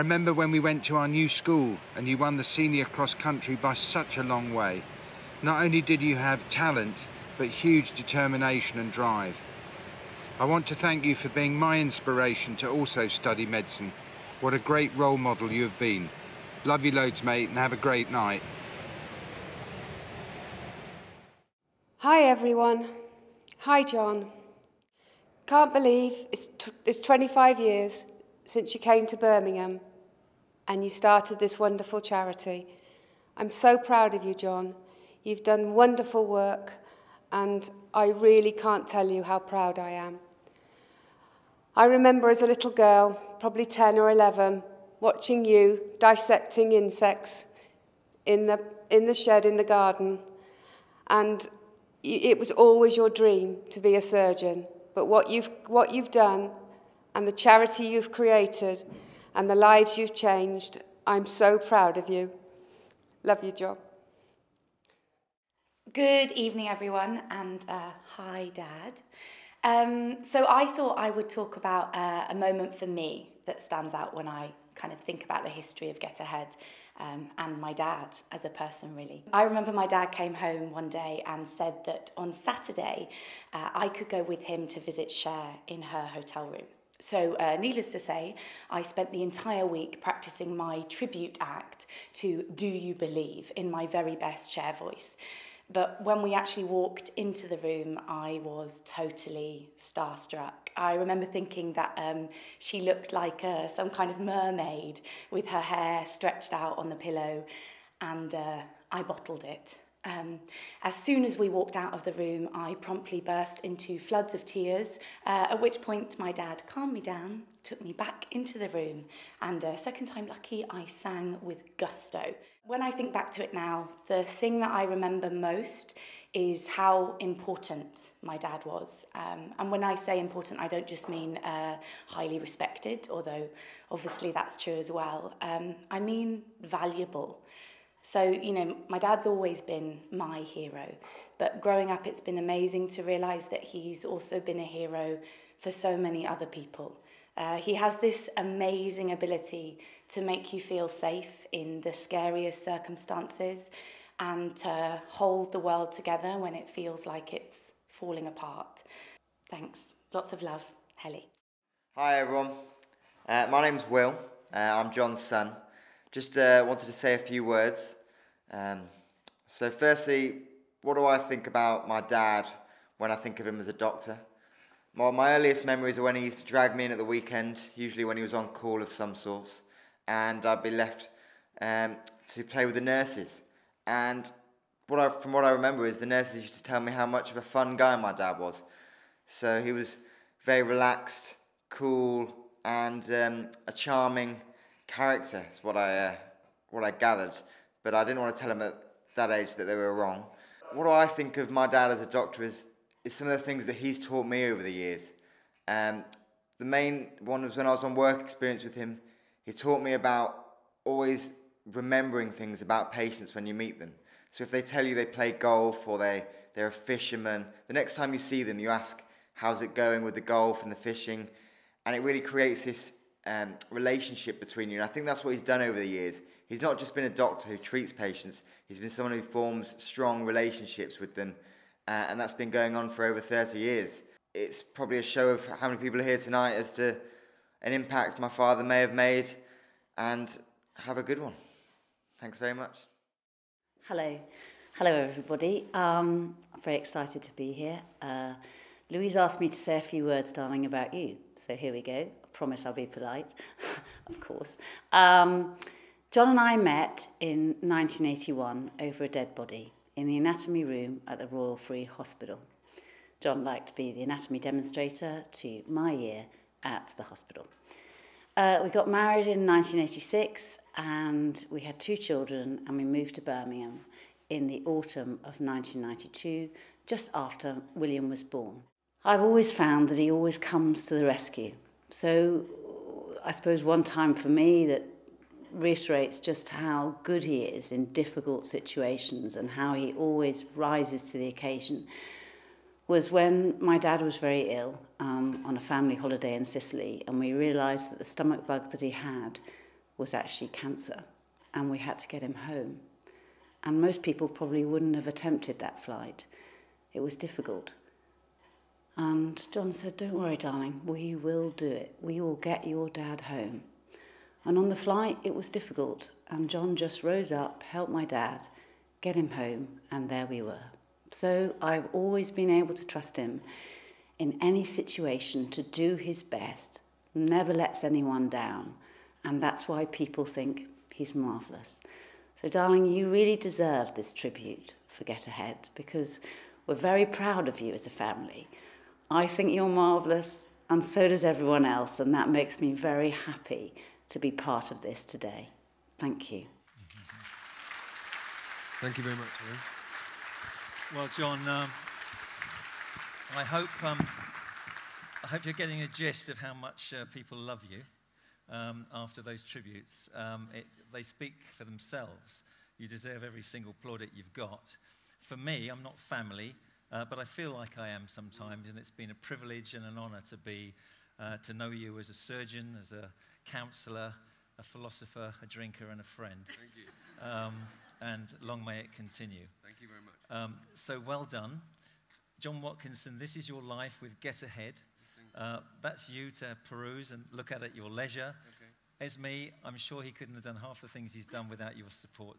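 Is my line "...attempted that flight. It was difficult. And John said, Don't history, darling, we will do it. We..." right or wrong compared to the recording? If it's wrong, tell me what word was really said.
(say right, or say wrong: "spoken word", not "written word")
wrong: "worry", not "history".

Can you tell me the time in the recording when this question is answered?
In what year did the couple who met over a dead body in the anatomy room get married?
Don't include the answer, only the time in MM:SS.
04:29.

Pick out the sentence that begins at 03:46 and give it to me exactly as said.
He's not just been a doctor who treats patients, he's been someone who forms strong relationships with them.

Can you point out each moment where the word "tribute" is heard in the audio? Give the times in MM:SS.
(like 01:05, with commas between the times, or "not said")
01:30, 05:34, 05:59.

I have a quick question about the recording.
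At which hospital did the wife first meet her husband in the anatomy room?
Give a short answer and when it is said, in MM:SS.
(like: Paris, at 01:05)
Royal Free Hospital, at 04:21.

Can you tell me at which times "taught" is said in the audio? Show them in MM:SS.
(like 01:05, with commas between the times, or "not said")
03:24, 03:29.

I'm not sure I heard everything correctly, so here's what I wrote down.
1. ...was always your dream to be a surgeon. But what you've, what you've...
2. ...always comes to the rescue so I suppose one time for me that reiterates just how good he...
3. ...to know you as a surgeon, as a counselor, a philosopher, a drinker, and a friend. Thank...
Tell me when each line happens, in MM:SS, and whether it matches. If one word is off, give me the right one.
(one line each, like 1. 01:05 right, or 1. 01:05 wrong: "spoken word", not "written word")
1. 00:52 right
2. 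04:40 right
3. 06:11 right.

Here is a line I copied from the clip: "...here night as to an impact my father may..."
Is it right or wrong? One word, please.
wrong.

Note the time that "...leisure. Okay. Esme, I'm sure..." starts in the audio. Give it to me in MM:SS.
06:27.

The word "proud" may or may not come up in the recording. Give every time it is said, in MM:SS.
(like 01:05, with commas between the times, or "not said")
00:33, 00:39, 01:01, 05:37.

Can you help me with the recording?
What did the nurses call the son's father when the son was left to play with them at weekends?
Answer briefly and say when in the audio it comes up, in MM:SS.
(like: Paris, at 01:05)
a fun guy, at 03:07.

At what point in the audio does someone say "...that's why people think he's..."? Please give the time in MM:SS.
05:29.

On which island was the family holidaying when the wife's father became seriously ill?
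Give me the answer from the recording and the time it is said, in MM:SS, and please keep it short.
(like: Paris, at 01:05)
Sicily, at 04:56.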